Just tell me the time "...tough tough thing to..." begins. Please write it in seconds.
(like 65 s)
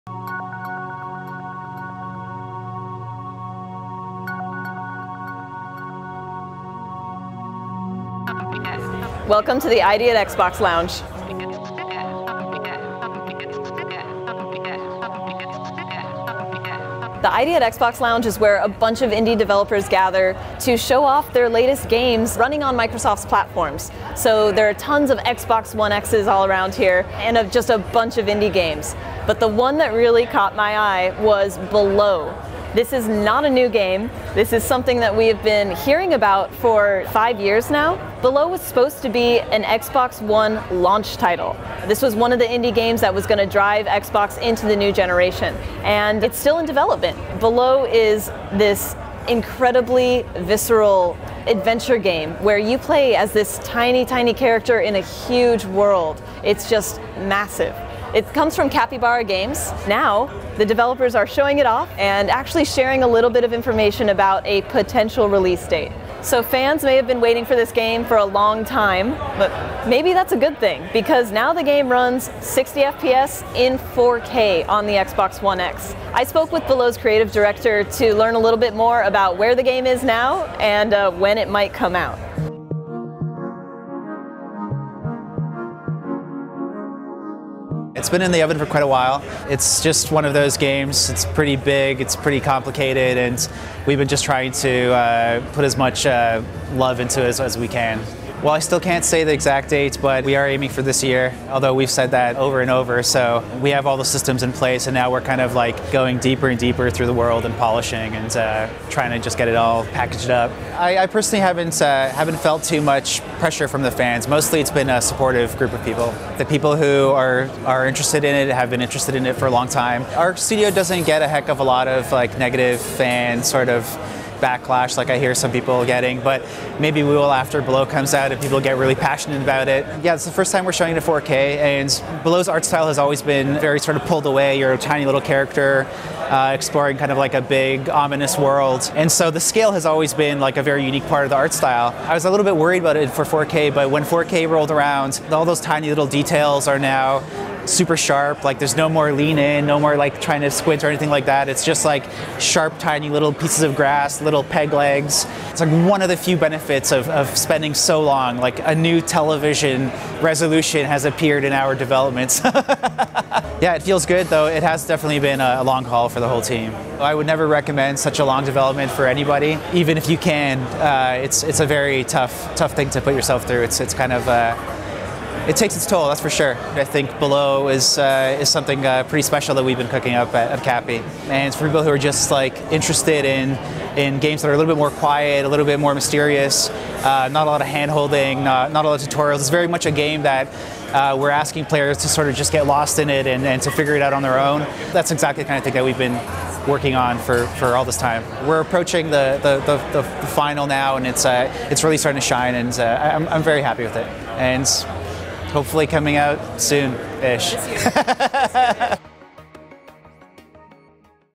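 172 s.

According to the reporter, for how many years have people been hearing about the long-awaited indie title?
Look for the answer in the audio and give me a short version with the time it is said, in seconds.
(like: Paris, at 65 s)
5, at 37 s.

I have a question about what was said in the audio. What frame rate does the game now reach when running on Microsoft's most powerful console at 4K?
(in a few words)
60 FPS.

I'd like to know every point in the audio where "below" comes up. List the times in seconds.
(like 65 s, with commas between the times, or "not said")
31 s, 38 s, 47 s, 76 s, 127 s, 132 s, 177 s.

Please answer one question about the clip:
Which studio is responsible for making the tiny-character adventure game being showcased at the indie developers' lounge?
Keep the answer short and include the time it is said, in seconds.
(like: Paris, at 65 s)
Capybara Games, at 58 s.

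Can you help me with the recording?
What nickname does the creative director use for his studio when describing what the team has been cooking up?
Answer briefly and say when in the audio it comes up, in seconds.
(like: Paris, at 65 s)
Cappy, at 180 s.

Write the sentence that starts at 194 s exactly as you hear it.
That's exactly the kind of thing that we've been working on for, for all this time.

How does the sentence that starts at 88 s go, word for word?
It's been in the oven for quite a while.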